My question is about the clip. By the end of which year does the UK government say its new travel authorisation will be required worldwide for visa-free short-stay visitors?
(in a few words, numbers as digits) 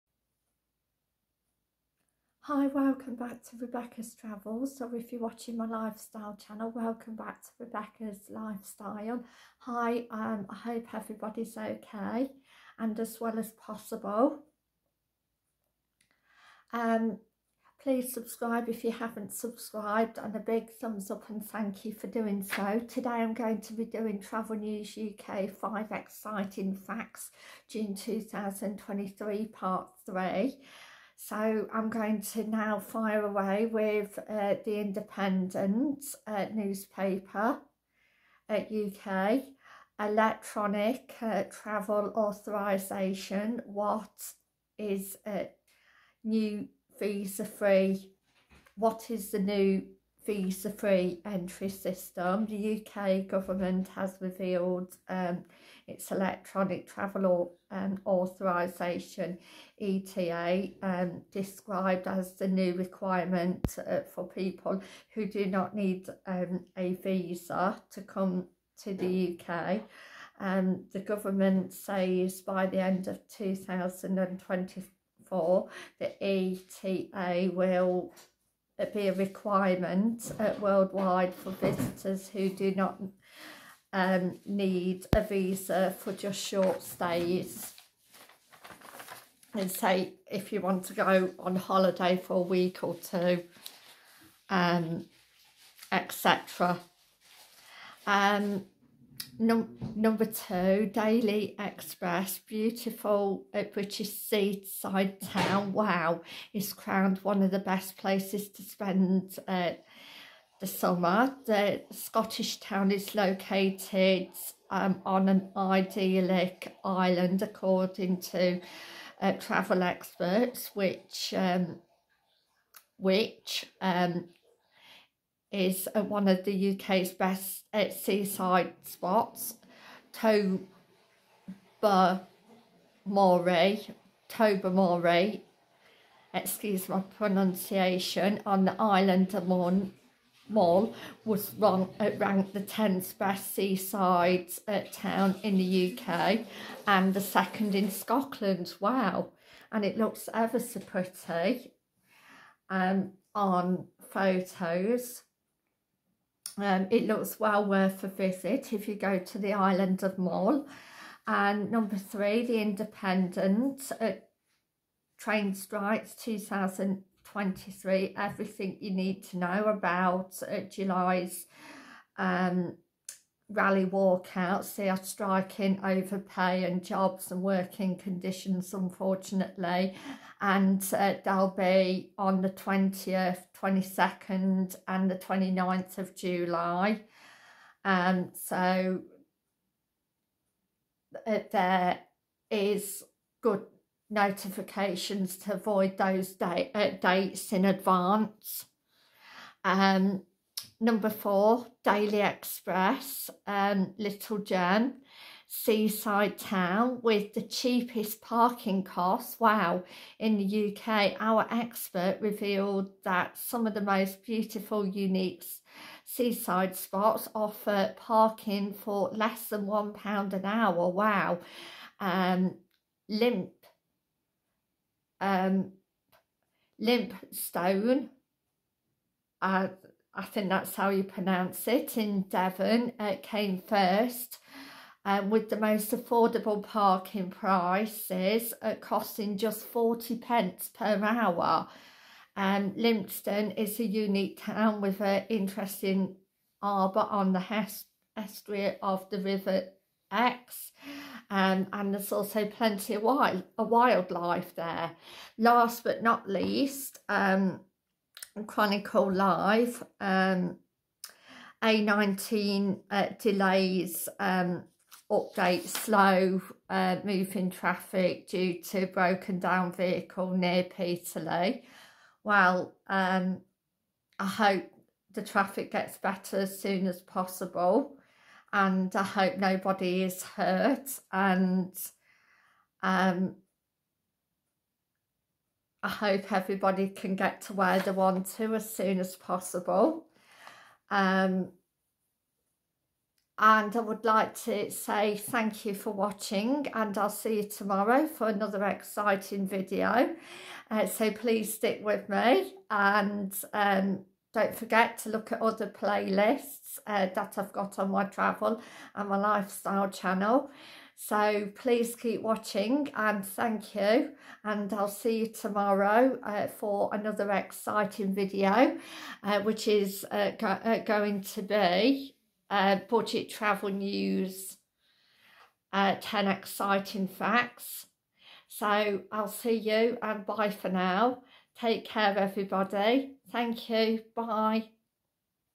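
2024.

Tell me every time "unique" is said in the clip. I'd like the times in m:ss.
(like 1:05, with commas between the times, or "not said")
3:34, 4:03.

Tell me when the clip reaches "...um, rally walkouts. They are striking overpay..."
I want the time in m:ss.
2:52.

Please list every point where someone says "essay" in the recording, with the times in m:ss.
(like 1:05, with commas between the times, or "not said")
not said.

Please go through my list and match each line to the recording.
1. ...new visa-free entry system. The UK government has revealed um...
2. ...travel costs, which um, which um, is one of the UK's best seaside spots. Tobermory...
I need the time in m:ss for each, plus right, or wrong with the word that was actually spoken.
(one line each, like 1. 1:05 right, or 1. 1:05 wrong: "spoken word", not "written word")
1. 0:49 right
2. 1:59 wrong: "experts", not "costs".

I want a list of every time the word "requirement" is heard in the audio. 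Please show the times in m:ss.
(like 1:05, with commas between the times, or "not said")
1:02, 1:19.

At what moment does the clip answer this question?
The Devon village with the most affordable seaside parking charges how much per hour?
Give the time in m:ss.
3:59.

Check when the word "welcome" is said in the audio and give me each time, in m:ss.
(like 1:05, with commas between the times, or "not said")
0:02, 0:06.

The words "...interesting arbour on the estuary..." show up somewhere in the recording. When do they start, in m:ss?
4:05.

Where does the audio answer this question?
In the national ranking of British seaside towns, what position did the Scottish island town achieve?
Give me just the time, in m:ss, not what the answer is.
2:22.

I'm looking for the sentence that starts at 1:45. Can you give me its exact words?
Wow, is crowned one of the best places to spend uh, the summer.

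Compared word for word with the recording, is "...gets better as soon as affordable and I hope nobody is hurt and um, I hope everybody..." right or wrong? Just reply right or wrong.
wrong.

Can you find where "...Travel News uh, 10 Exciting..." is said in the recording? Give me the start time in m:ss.
5:23.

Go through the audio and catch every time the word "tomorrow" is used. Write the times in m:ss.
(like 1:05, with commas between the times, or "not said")
4:57, 5:15.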